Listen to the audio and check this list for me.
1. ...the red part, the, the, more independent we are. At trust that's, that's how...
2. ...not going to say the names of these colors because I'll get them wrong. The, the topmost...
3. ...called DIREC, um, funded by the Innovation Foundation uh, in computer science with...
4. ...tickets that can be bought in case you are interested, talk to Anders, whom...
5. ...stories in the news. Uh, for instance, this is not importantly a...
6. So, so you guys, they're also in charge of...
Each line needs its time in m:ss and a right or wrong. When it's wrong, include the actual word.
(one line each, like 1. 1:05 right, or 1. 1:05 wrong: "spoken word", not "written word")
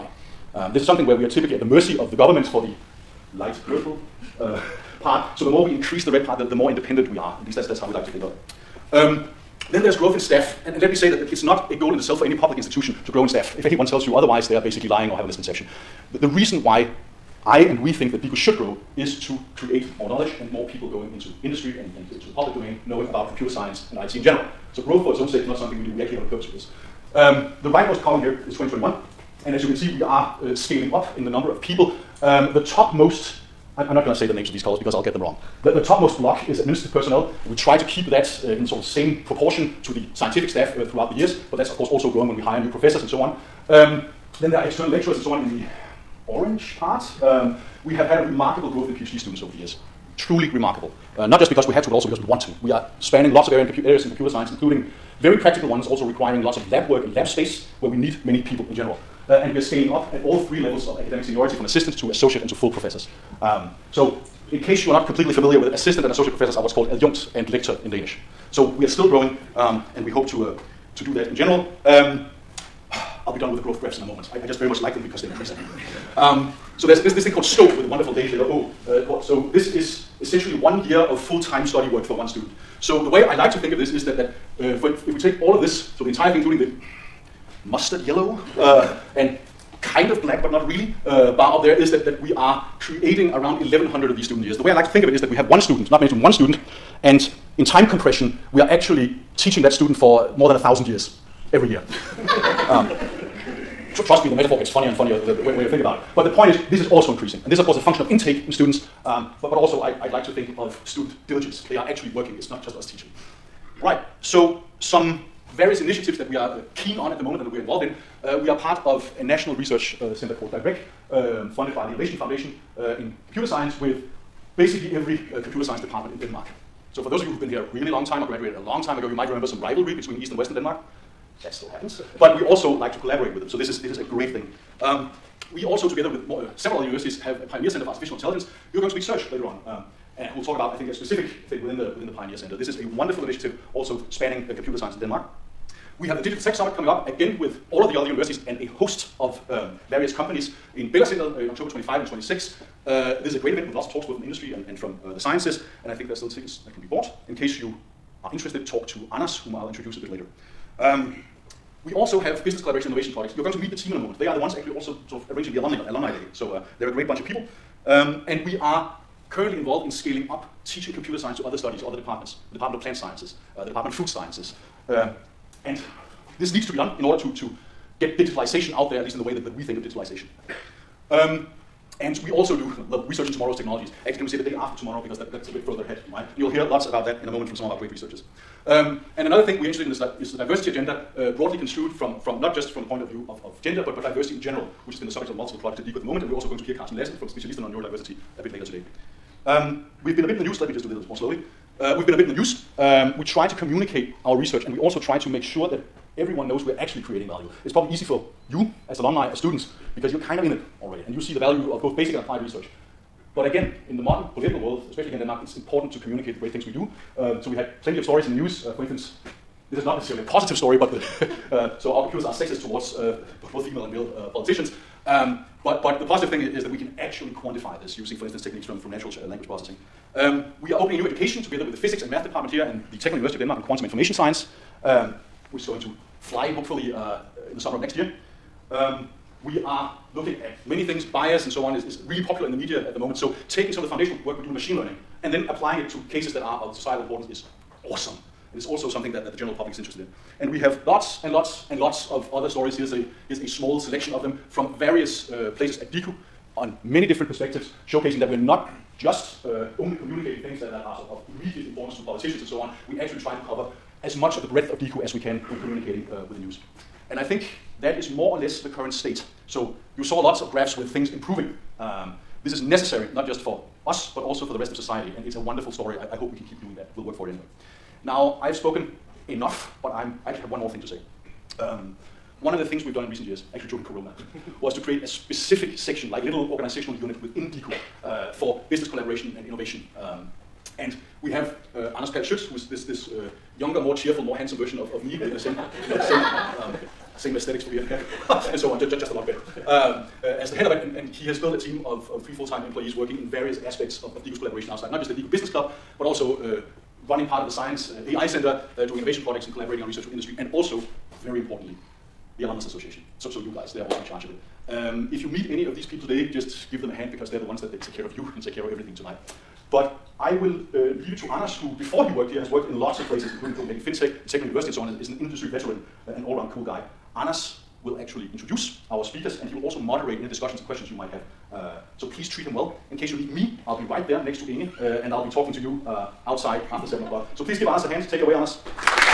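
1. 0:06 wrong: "least", not "trust"
2. 0:33 right
3. 2:00 right
4. 2:36 right
5. 3:38 wrong: "necessarily", not "importantly"
6. 5:13 right.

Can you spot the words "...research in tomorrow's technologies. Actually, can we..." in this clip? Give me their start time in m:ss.
3:03.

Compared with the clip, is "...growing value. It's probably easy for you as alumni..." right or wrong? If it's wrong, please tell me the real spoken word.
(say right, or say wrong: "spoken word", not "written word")
wrong: "creating", not "growing".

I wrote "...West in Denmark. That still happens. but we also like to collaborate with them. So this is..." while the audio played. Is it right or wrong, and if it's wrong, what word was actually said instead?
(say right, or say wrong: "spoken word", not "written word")
right.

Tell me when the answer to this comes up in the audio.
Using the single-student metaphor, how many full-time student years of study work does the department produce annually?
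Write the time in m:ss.
1:33.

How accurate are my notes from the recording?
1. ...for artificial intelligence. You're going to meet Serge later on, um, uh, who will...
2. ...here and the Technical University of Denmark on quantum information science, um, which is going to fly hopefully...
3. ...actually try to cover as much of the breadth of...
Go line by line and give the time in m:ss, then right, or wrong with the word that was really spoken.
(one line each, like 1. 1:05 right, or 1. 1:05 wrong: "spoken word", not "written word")
1. 2:17 right
2. 3:52 right
3. 4:22 right.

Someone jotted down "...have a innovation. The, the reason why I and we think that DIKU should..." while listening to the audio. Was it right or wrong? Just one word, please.
wrong.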